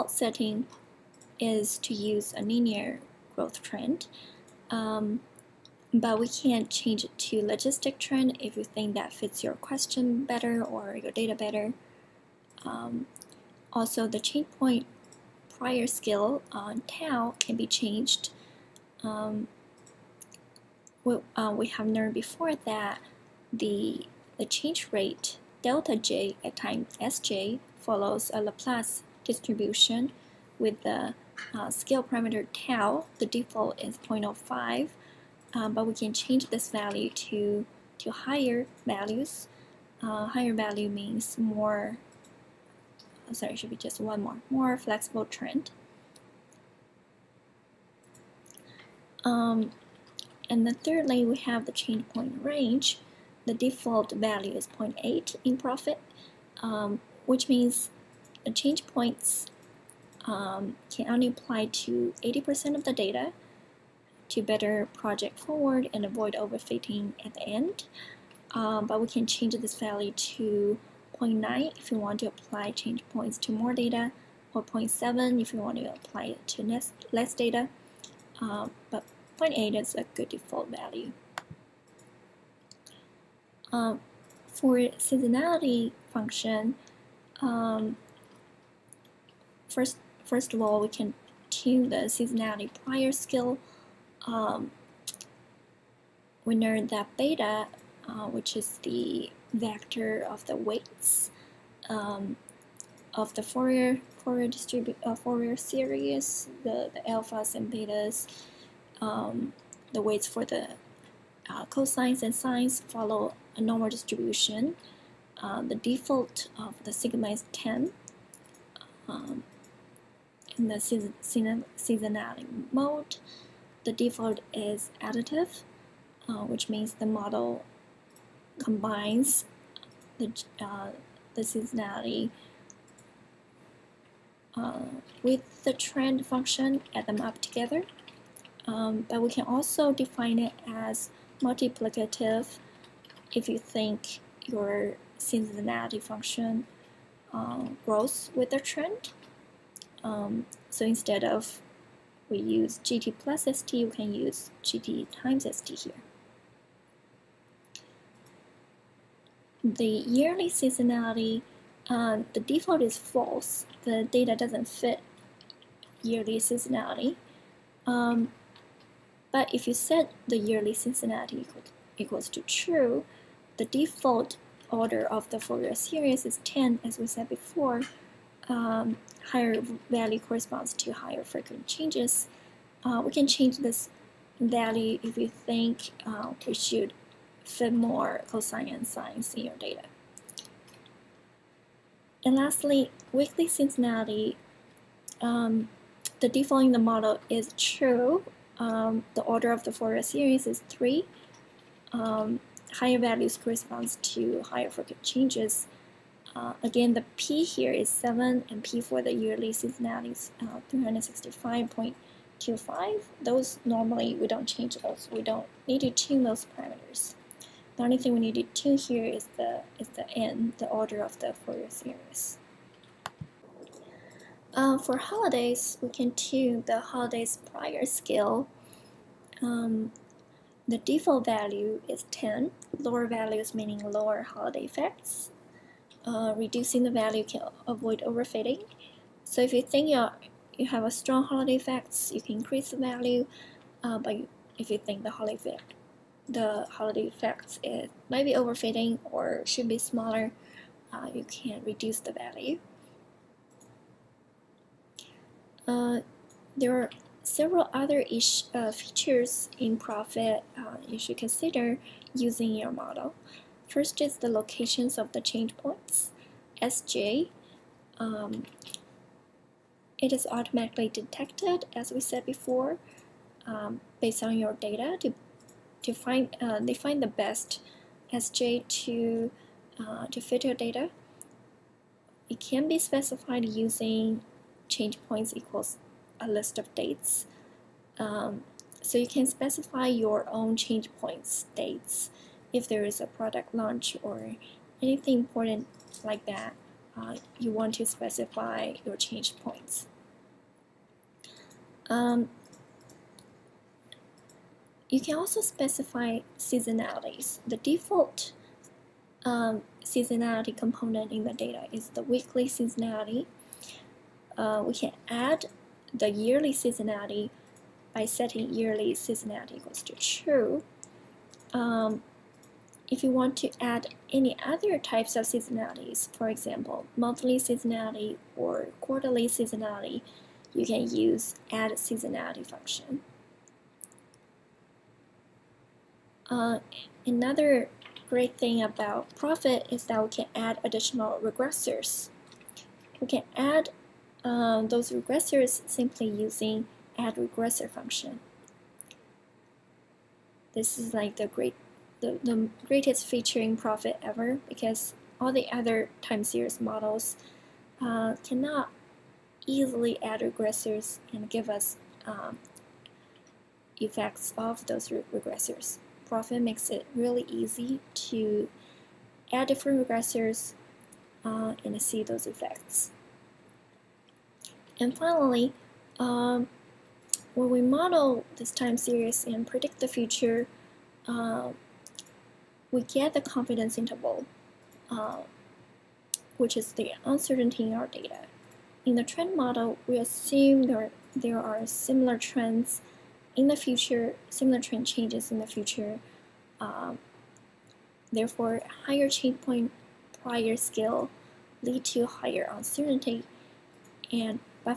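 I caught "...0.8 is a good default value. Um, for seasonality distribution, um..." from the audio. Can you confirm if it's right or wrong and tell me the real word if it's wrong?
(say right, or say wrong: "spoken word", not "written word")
wrong: "function", not "distribution".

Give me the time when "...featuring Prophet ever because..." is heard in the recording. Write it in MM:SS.
05:53.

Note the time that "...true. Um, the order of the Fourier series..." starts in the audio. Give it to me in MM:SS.
03:17.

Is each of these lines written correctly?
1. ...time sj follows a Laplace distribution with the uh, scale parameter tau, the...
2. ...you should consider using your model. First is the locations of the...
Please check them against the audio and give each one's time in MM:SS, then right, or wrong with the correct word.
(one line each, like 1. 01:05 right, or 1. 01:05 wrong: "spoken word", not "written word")
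1. 00:26 right
2. 04:20 right.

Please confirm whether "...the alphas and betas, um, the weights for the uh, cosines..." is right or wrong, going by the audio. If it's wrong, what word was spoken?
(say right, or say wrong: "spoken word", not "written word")
right.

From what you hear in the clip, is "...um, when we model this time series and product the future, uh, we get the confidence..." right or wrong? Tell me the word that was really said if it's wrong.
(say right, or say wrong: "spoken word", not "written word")
wrong: "predict", not "product".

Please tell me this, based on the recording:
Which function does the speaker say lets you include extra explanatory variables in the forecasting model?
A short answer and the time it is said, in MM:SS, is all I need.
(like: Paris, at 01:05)
add regressor, at 05:46.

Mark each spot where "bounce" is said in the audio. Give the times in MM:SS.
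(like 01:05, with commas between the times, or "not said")
not said.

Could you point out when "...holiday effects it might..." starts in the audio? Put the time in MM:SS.
04:06.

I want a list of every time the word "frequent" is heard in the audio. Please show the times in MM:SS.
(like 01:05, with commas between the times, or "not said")
03:01, 03:24.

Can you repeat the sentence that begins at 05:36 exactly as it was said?
Uh, another great thing about Prophet is that we can add additional regressors.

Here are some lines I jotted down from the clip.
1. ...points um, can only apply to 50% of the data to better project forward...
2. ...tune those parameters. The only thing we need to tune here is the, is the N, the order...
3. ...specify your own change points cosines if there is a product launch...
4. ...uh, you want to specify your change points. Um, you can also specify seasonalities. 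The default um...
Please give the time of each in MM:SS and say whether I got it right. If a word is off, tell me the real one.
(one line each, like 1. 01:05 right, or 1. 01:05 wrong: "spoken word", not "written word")
1. 00:58 wrong: "80", not "50"
2. 03:35 right
3. 04:49 wrong: "dates", not "cosines"
4. 04:56 right.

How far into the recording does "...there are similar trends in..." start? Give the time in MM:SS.
06:31.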